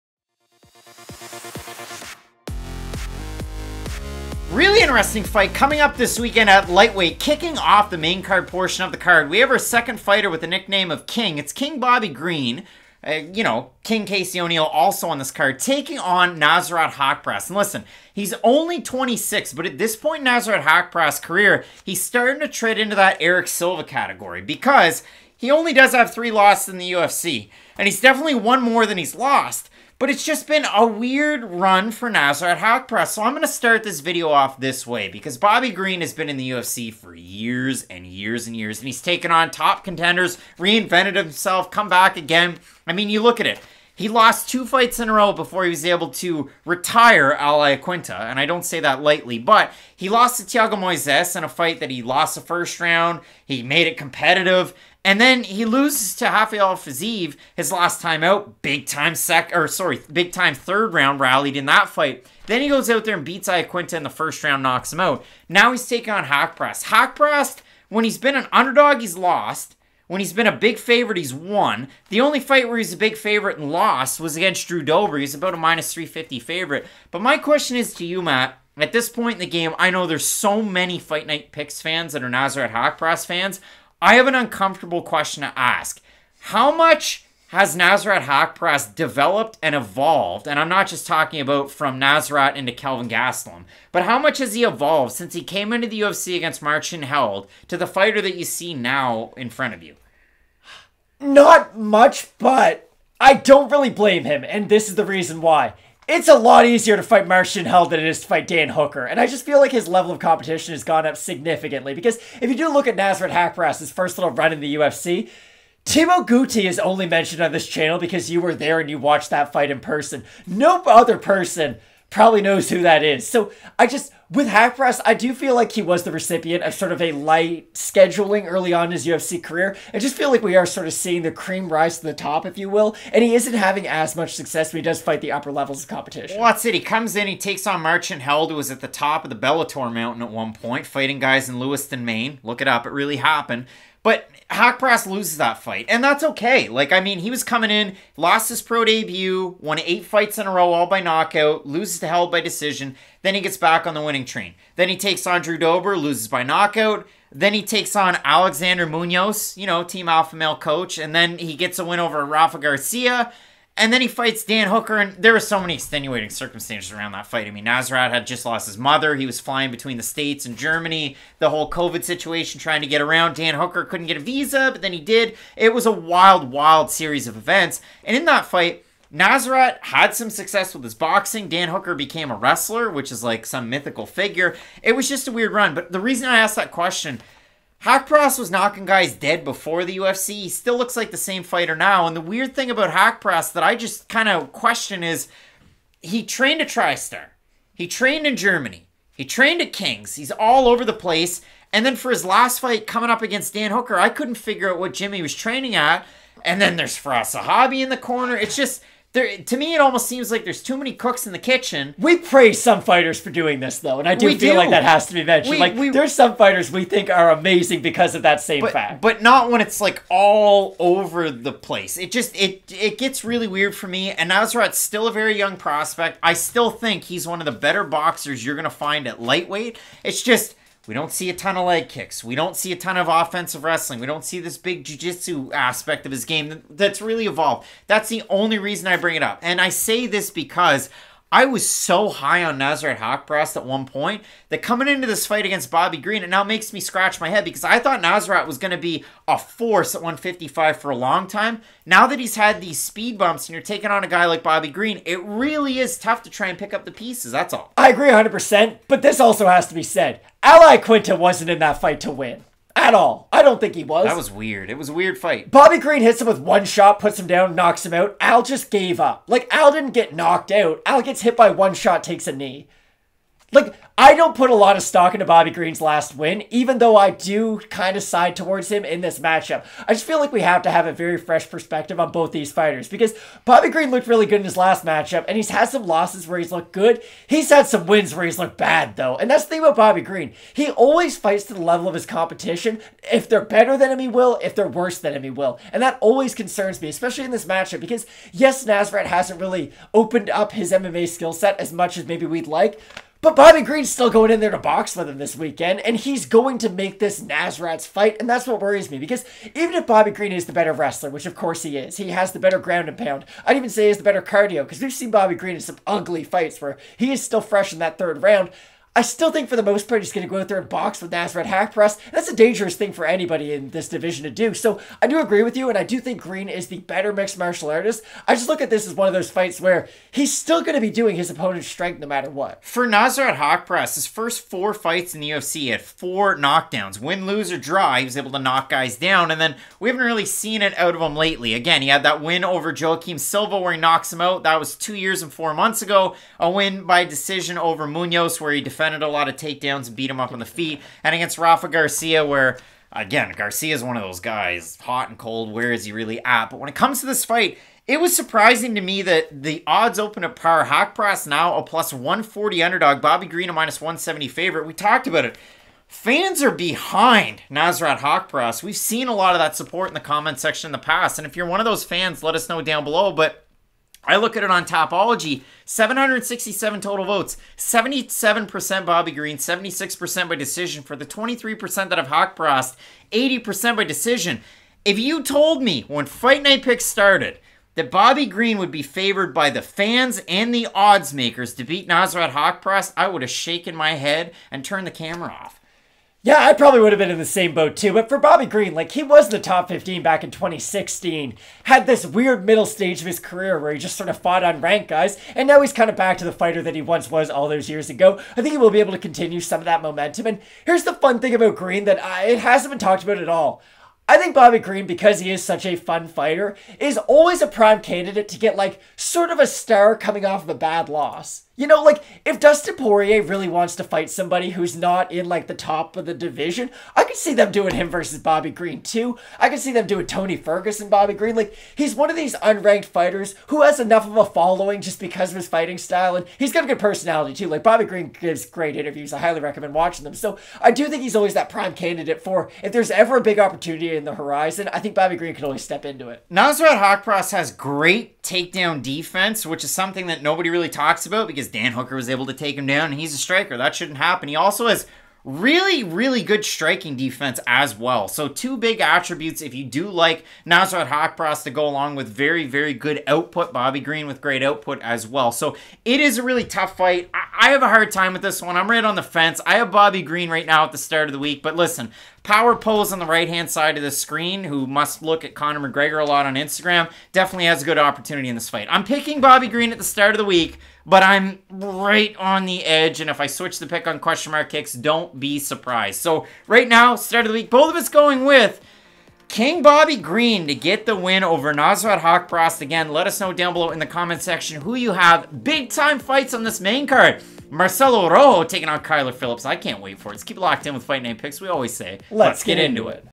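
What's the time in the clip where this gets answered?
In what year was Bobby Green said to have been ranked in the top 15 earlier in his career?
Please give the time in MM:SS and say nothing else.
06:40.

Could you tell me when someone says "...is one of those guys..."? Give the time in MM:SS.
05:53.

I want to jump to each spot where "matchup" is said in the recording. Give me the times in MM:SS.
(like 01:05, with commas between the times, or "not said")
04:39, 04:44, 04:57.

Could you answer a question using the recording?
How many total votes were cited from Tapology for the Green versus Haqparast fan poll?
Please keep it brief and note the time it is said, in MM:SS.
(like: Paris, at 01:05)
767, at 06:15.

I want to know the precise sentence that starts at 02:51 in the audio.
The whole COVID situation, trying to get around.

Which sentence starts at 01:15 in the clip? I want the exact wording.
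He's about a minus 350 favorite.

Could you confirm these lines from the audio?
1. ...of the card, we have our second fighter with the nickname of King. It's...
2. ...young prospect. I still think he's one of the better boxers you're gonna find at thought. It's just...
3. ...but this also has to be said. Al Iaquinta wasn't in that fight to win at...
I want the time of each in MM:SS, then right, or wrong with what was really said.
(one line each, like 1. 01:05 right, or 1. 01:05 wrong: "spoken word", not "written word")
1. 00:08 right
2. 03:45 wrong: "lightweight", not "thought"
3. 04:18 right.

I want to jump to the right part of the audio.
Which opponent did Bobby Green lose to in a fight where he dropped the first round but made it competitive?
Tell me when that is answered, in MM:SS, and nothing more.
00:50.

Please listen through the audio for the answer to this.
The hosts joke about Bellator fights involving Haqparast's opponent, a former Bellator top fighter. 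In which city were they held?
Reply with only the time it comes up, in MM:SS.
02:21.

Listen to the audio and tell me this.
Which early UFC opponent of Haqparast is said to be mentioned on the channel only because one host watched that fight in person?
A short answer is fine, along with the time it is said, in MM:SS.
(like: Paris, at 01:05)
Thibault Gouti, at 01:55.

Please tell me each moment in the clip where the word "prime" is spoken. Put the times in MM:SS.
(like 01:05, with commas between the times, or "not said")
06:57, 07:21.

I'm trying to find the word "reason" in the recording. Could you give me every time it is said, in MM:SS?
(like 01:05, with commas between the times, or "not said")
01:45, 03:06, 03:58.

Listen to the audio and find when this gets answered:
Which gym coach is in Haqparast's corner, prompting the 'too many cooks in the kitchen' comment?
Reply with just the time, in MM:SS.
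03:26.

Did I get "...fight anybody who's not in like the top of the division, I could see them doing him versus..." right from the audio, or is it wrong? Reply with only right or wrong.
wrong.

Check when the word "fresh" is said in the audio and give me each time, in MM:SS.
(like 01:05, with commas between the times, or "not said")
04:41, 05:17.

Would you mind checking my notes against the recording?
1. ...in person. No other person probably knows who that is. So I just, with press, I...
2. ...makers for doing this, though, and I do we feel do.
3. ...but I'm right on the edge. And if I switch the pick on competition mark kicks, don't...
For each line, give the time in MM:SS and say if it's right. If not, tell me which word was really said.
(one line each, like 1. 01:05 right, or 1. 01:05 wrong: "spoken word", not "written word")
1. 01:59 right
2. 03:32 wrong: "fighters", not "makers"
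3. 08:00 wrong: "question", not "competition".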